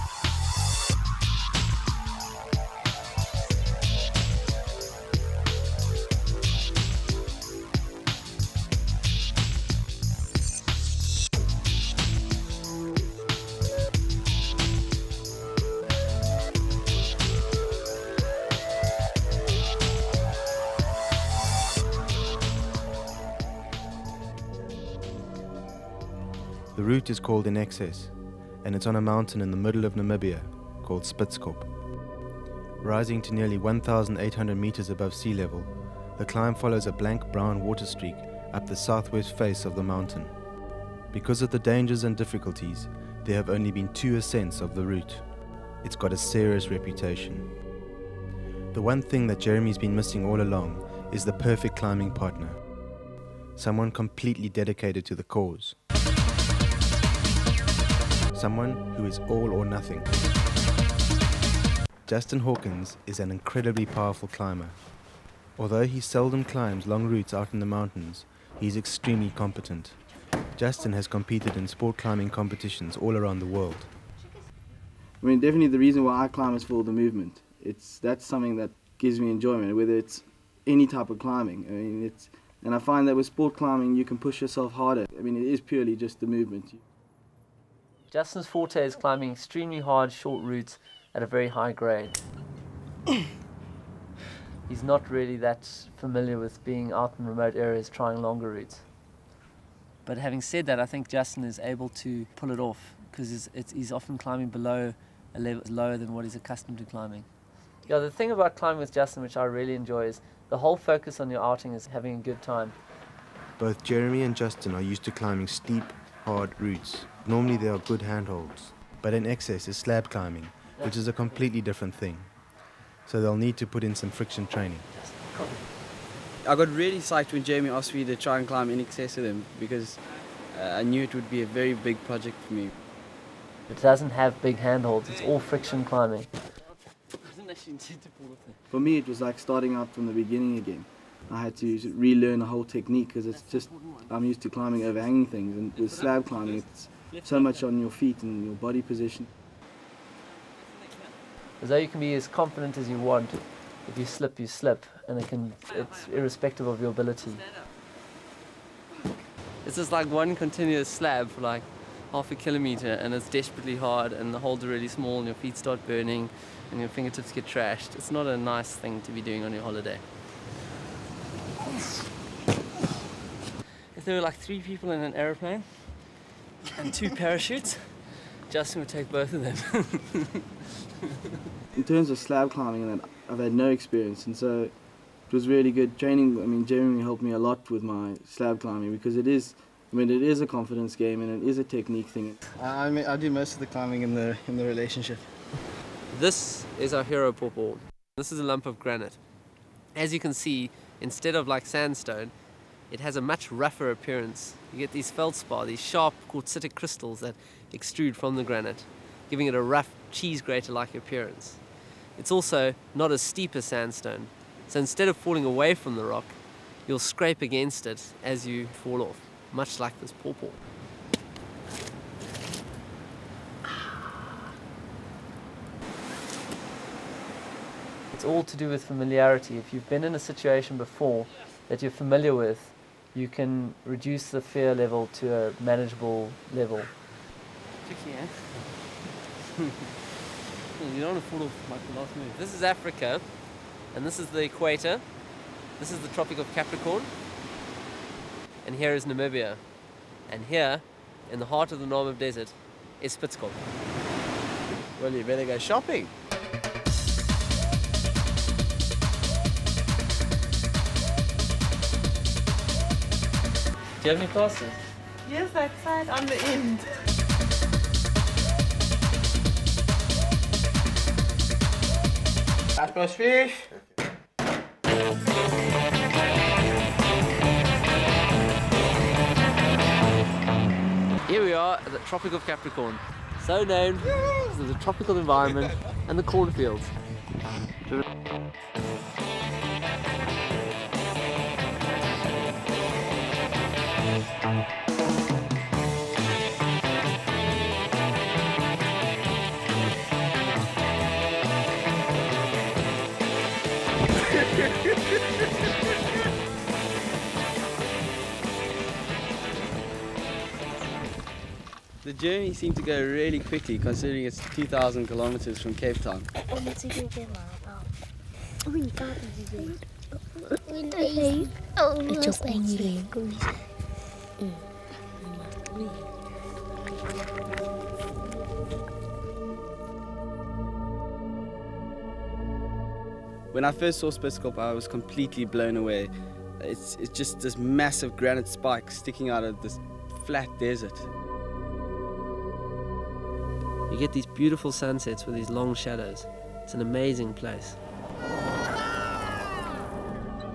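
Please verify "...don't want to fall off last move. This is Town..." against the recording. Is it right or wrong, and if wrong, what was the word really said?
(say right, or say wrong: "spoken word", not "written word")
wrong: "Africa", not "Town".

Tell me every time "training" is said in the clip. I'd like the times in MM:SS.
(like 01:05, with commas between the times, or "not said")
02:04, 03:05.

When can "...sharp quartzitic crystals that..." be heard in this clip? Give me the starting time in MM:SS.
03:25.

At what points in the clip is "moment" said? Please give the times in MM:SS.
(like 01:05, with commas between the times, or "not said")
not said.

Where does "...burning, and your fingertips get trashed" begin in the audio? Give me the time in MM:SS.
02:45.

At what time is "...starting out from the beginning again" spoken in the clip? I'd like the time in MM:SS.
02:19.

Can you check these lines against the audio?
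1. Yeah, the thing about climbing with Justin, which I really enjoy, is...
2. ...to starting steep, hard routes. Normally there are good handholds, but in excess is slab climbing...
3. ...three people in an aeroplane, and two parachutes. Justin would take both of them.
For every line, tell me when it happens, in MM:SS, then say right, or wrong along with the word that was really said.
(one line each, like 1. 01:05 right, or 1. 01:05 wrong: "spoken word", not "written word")
1. 01:47 right
2. 01:55 wrong: "climbing", not "starting"
3. 02:54 right.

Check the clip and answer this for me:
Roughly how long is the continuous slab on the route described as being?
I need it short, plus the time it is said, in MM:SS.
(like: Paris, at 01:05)
Half a kilometer, at 02:42.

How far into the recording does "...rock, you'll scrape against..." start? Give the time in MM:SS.
03:36.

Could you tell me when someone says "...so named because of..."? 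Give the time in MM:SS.
04:43.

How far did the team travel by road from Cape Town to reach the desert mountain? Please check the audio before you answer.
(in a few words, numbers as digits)
2,000 kilometers.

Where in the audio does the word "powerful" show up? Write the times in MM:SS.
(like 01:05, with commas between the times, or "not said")
01:03.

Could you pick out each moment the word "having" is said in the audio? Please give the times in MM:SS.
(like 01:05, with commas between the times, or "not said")
01:40, 01:51.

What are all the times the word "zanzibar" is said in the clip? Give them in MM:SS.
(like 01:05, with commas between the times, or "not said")
not said.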